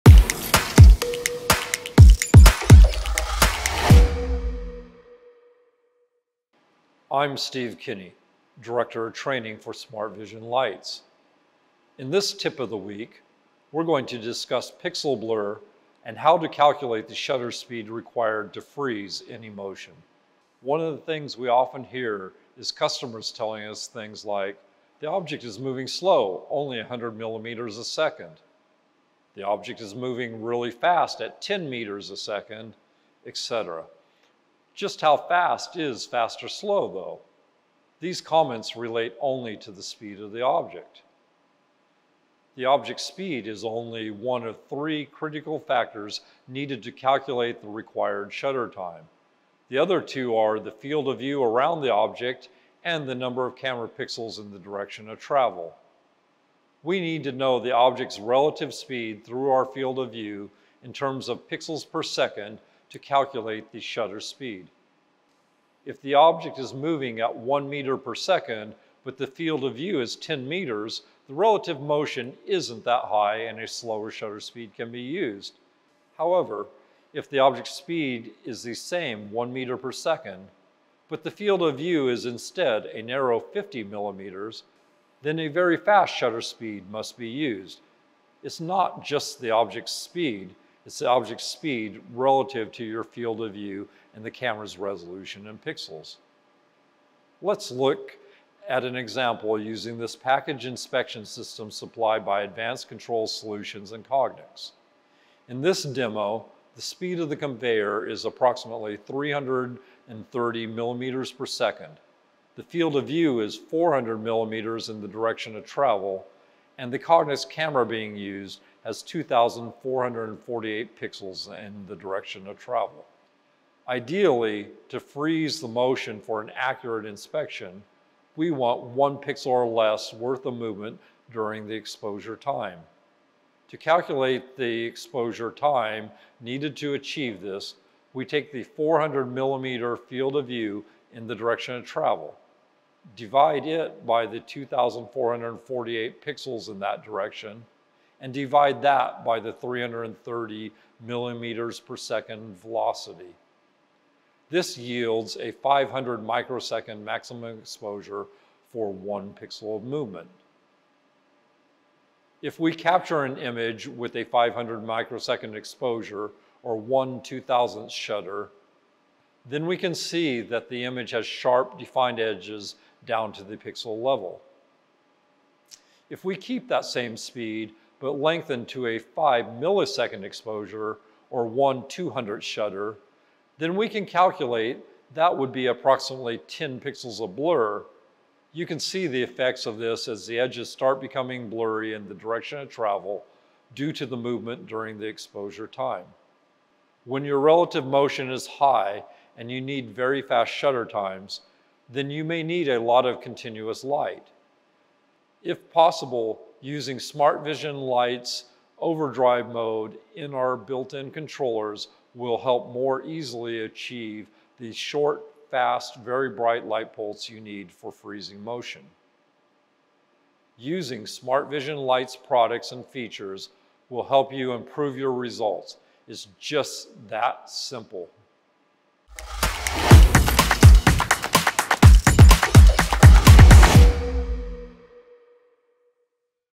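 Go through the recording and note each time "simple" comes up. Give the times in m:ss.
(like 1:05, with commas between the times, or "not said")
3:47.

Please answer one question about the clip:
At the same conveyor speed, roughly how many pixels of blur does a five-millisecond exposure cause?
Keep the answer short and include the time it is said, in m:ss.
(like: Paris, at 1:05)
10, at 3:06.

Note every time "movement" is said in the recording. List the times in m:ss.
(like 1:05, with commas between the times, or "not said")
2:10, 2:39, 3:14.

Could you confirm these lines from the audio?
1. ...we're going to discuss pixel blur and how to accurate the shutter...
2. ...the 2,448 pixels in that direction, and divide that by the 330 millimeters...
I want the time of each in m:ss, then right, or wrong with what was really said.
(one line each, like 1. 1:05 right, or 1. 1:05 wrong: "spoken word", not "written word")
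1. 0:13 wrong: "calculate", not "accurate"
2. 2:24 right.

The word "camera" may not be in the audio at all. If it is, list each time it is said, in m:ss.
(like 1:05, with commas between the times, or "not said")
0:53, 1:34, 1:57.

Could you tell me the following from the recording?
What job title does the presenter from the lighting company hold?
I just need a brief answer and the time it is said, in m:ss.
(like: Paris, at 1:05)
Director of Training, at 0:08.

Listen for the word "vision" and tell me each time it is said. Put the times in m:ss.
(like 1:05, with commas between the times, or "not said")
0:10, 3:27, 3:41.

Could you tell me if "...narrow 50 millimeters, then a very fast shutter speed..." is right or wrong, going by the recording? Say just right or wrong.
right.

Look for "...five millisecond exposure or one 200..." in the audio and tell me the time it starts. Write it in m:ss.
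2:58.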